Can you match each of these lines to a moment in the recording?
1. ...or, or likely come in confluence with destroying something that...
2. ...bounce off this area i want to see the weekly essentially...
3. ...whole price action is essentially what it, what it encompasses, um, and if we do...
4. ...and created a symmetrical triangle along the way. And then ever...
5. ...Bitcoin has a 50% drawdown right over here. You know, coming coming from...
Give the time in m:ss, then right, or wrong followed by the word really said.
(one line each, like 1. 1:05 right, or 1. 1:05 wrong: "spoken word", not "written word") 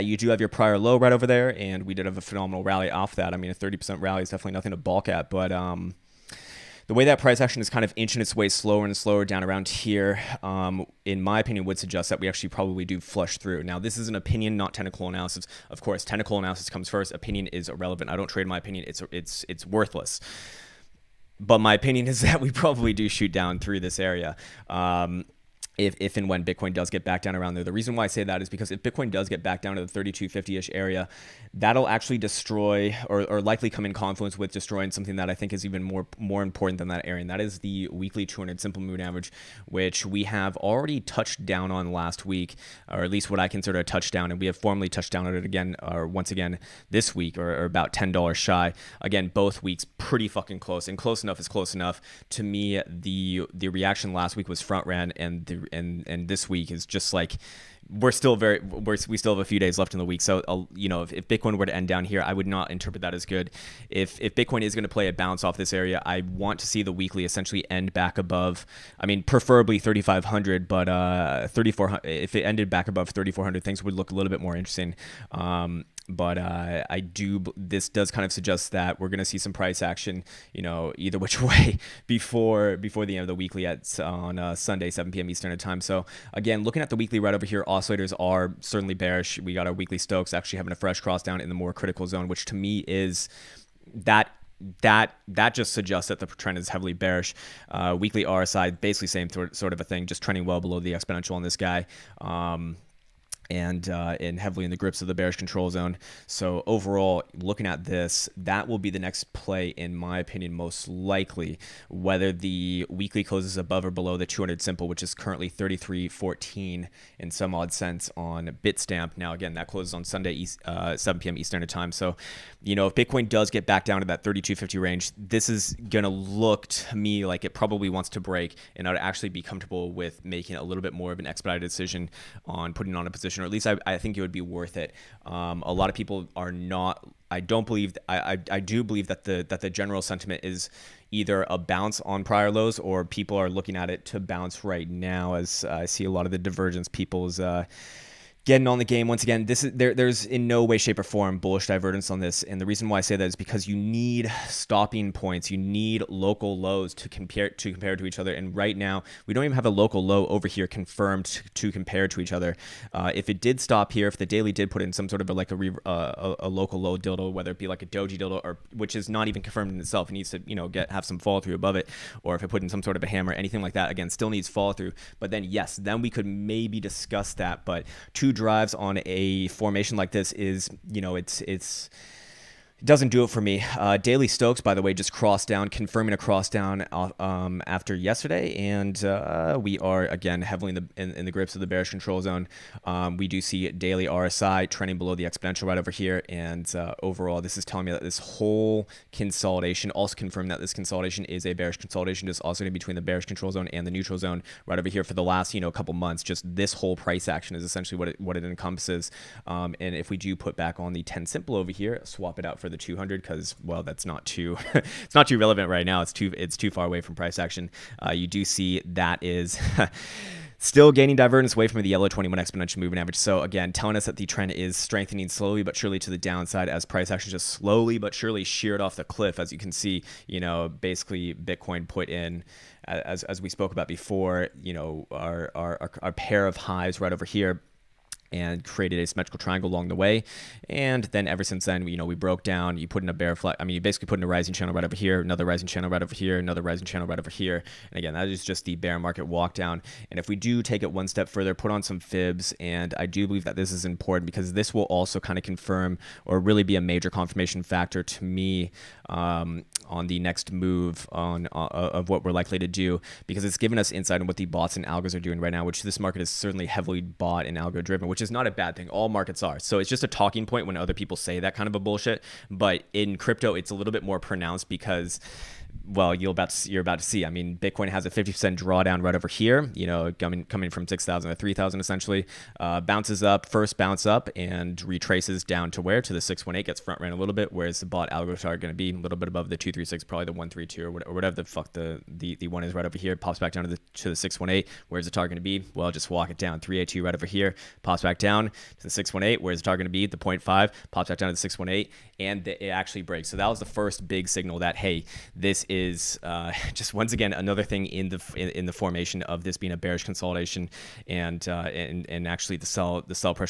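1. 0:33 right
2. 1:05 right
3. 3:26 right
4. 3:58 right
5. 4:37 right.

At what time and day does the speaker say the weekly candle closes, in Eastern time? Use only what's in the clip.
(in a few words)
Sunday, 7 p.m.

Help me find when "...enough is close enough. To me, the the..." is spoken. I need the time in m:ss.
0:51.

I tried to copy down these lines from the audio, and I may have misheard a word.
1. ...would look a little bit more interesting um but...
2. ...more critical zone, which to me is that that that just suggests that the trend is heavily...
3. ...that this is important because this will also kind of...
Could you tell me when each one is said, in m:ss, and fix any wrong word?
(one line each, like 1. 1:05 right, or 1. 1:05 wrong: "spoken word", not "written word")
1. 1:13 right
2. 1:31 right
3. 4:13 right.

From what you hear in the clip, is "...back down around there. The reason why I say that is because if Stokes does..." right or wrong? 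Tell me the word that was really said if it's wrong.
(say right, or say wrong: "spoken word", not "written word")
wrong: "Bitcoin", not "Stokes".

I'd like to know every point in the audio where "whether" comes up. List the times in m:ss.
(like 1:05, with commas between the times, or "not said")
1:51, 2:47.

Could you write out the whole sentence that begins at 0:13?
Now, this is an opinion, not technical analysis.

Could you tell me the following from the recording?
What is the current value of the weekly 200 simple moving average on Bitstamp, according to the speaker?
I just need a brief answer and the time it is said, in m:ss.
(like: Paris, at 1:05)
33.14, at 1:55.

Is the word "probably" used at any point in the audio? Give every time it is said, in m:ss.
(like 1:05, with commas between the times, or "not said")
0:12, 0:22, 2:07, 4:50.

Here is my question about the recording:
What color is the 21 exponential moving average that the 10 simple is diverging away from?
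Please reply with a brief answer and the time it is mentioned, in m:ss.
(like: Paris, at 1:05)
Yellow, at 3:41.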